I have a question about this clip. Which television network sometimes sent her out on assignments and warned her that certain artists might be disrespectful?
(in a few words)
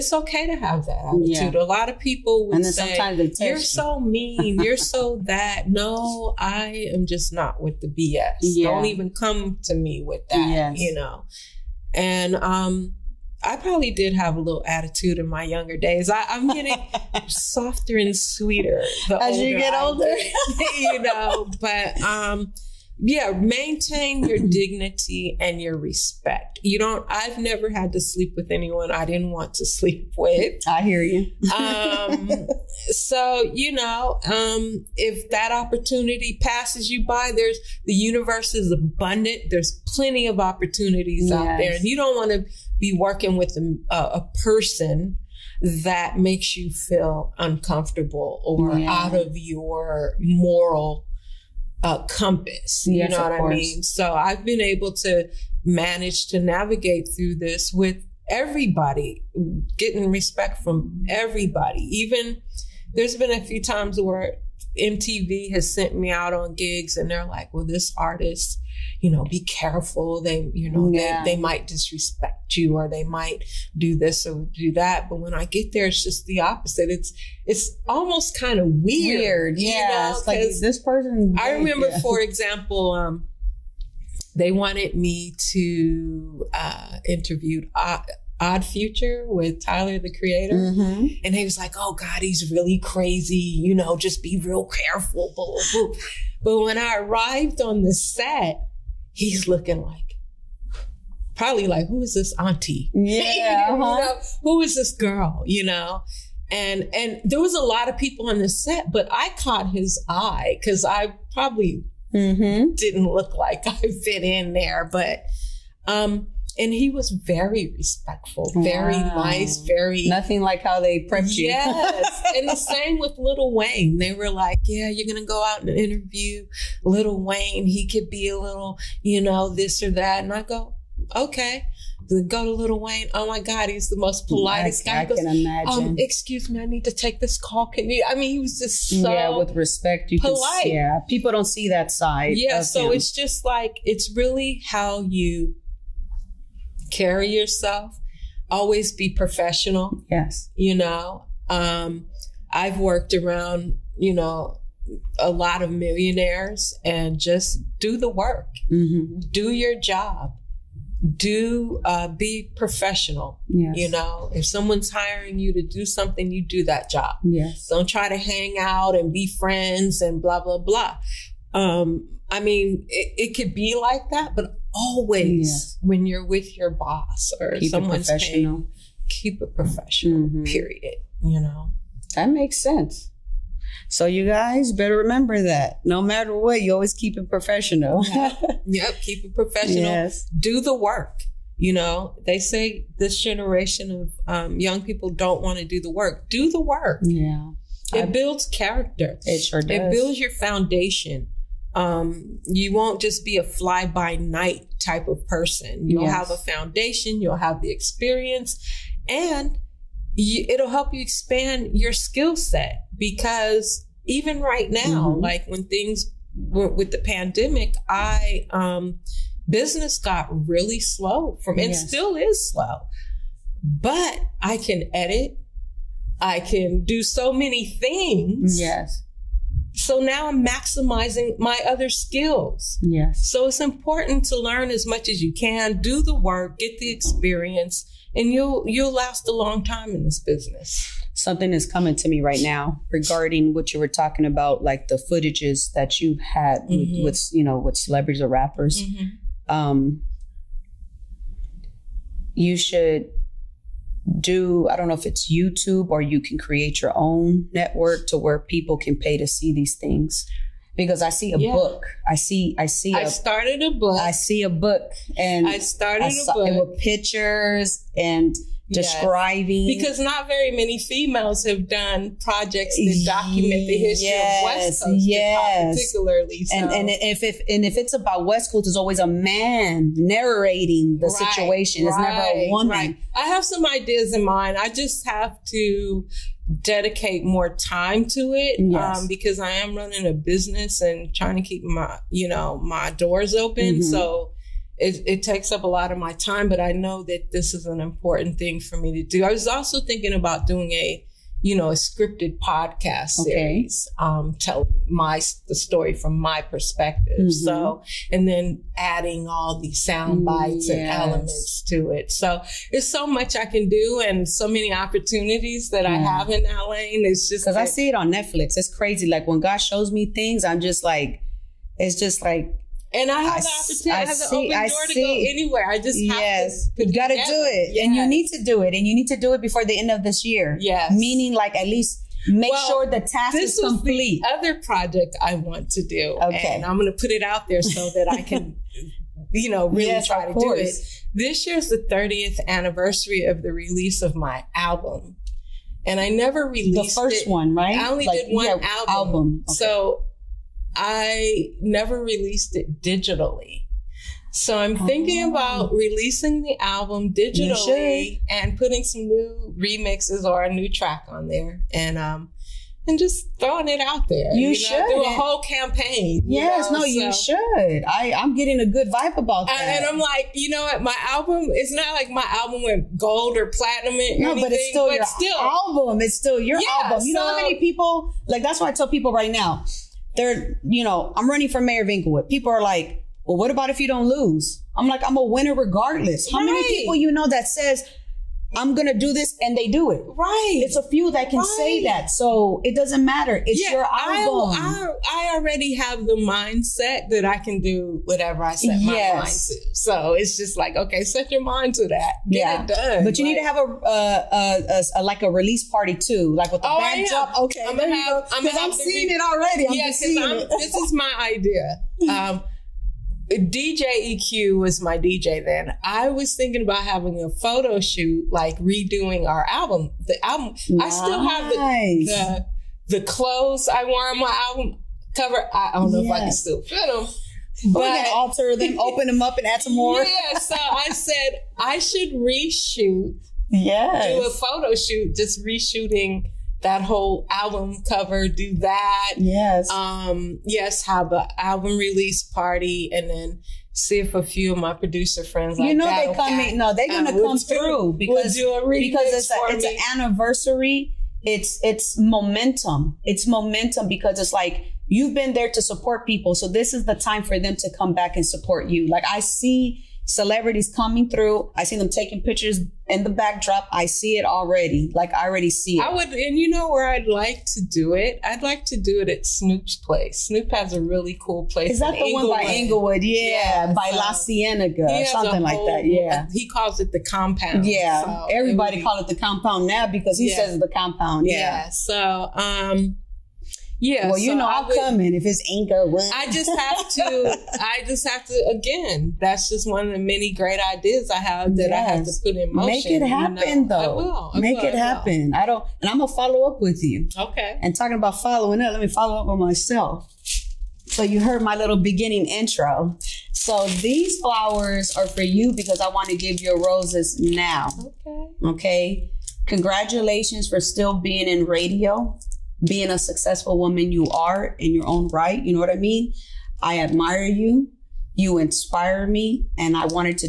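MTV.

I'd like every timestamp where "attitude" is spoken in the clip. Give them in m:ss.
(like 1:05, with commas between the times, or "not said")
0:01, 0:14.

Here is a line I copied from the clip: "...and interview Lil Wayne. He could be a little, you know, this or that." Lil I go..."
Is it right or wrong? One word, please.
wrong.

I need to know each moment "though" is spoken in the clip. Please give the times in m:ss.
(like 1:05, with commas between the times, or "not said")
8:13.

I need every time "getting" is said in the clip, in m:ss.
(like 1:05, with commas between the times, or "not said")
0:16, 0:59, 6:08.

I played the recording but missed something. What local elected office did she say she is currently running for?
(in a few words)
Mayor.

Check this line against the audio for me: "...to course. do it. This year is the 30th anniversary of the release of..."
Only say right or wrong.
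right.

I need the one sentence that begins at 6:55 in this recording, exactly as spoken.
I was thinking about having a photo shoot, like redoing our album.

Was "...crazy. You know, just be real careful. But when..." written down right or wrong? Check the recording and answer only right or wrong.
right.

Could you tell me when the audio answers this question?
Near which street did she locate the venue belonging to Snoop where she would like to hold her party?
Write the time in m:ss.
7:53.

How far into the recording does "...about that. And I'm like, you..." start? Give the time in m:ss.
6:09.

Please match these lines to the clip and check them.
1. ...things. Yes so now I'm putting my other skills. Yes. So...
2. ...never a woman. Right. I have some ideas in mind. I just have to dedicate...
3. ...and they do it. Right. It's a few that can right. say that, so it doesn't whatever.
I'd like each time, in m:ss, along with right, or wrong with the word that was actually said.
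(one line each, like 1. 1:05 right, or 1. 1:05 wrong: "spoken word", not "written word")
1. 3:47 wrong: "maximizing", not "putting"
2. 4:42 right
3. 6:29 wrong: "matter", not "whatever".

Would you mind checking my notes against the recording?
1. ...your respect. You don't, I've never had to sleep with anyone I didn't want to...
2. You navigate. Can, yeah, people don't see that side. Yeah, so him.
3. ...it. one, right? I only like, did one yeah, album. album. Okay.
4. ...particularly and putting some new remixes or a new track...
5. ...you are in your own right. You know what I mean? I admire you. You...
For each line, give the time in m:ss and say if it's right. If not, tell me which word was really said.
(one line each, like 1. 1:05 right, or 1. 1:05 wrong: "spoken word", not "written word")
1. 0:25 right
2. 2:20 wrong: "polite", not "navigate"
3. 5:47 right
4. 5:57 wrong: "digitally", not "particularly"
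5. 8:33 right.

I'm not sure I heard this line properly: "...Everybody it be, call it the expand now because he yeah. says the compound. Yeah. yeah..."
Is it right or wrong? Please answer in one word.
wrong.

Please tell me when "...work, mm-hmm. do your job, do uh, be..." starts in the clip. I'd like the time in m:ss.
2:38.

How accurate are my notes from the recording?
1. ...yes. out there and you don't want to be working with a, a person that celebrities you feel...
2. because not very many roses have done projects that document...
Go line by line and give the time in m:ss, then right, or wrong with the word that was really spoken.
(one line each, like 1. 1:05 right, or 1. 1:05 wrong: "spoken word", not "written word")
1. 0:41 wrong: "makes", not "celebrities"
2. 4:29 wrong: "females", not "roses".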